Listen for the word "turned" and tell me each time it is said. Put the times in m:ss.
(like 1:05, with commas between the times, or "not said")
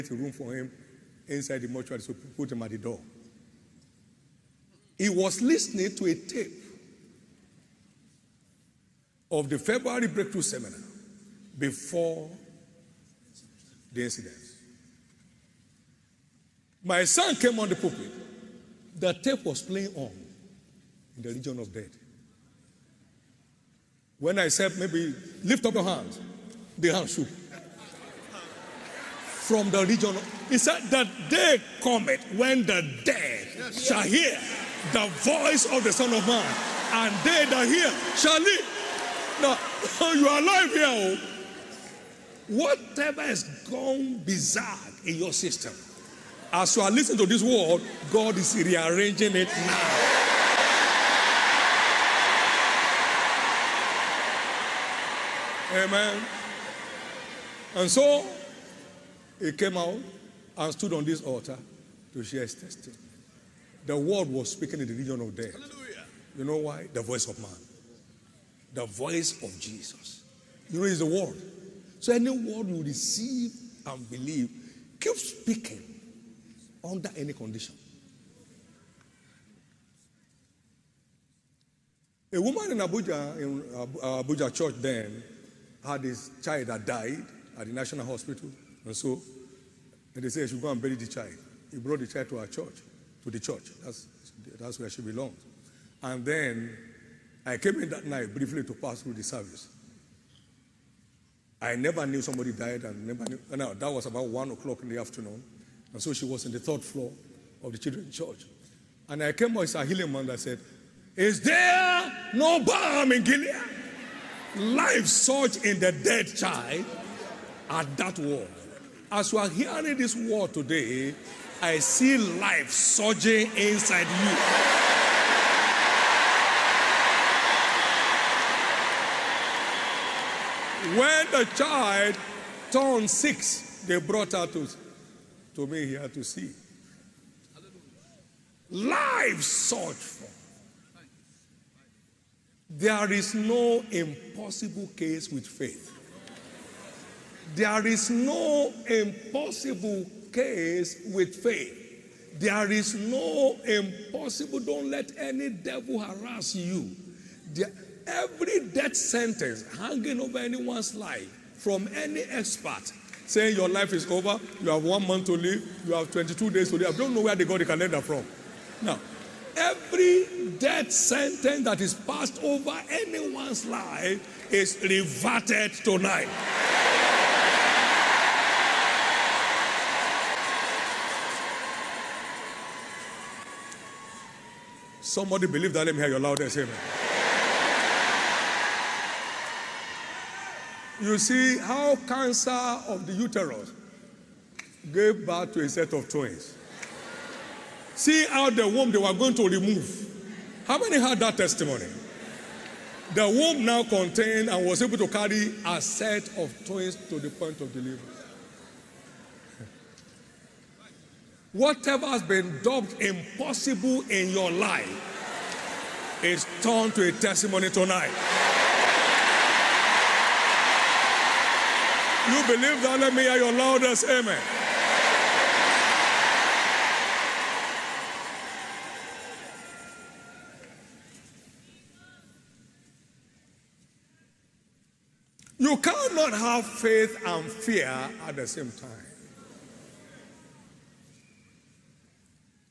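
2:12, 3:36.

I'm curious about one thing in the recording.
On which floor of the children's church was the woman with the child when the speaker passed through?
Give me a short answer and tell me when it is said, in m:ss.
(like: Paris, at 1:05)
Third floor, at 1:46.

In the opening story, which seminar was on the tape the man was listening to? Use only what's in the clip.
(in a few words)
February breakthrough seminar.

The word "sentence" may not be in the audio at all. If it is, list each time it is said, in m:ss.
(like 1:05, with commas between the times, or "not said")
2:38, 2:50.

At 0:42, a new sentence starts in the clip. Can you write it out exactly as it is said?
Whatever has gone bizarre in your system, as you are listening to this word, God is rearranging it now.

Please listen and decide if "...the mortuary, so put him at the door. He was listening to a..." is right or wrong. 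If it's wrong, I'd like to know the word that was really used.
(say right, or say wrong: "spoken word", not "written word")
right.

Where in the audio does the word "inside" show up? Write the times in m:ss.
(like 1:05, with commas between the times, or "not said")
0:01, 2:03.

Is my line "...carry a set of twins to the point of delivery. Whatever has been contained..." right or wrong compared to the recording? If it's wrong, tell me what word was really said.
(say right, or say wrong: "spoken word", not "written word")
wrong: "dubbed", not "contained".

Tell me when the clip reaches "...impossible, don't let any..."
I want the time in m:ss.
2:33.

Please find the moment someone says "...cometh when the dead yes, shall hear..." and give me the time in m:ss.
0:31.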